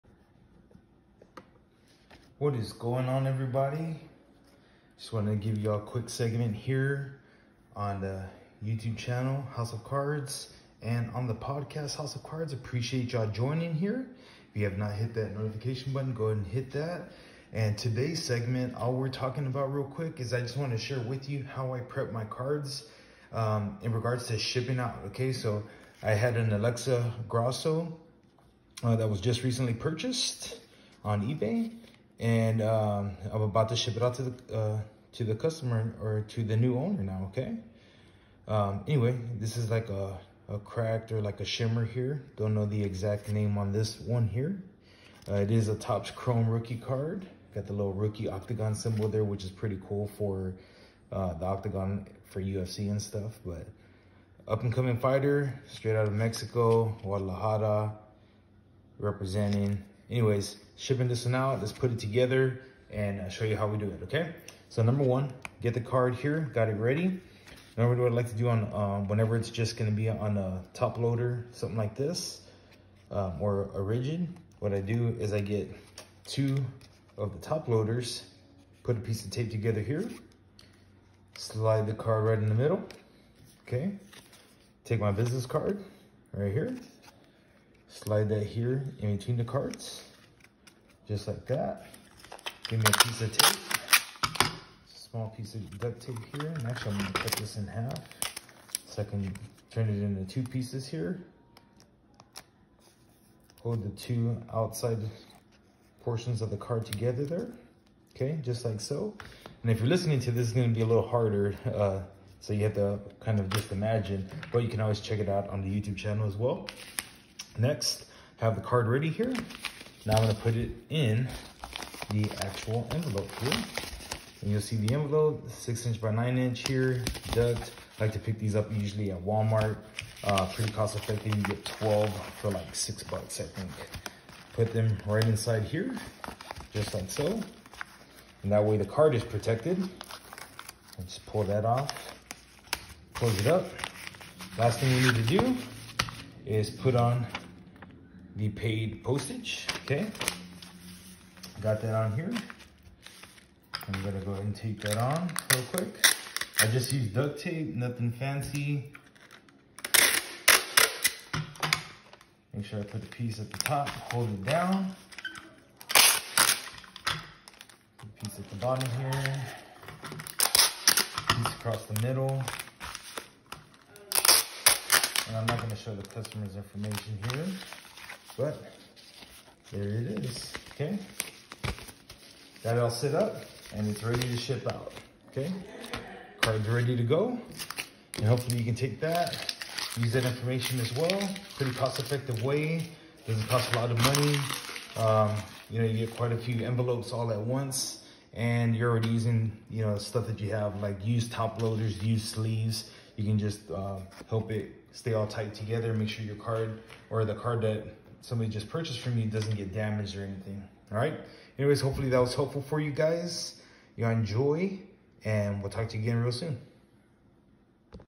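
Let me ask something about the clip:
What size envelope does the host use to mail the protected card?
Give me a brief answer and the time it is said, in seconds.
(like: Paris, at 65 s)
6 inch by 9 inch, at 125 s.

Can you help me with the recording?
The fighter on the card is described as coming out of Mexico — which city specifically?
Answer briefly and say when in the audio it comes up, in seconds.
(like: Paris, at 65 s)
Guadalajara, at 57 s.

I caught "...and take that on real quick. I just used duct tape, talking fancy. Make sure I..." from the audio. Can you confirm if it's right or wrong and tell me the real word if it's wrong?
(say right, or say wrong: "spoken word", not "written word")
wrong: "nothing", not "talking".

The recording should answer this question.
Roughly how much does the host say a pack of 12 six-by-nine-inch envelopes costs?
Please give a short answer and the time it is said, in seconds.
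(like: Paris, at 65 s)
$6, at 132 s.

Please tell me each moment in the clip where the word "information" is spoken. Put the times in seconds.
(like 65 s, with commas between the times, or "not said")
176 s, 190 s.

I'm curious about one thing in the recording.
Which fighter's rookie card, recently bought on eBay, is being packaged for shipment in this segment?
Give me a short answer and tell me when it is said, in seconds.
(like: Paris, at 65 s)
Alexa Grasso, at 26 s.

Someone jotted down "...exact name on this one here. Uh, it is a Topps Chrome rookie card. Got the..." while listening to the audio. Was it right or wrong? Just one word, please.
right.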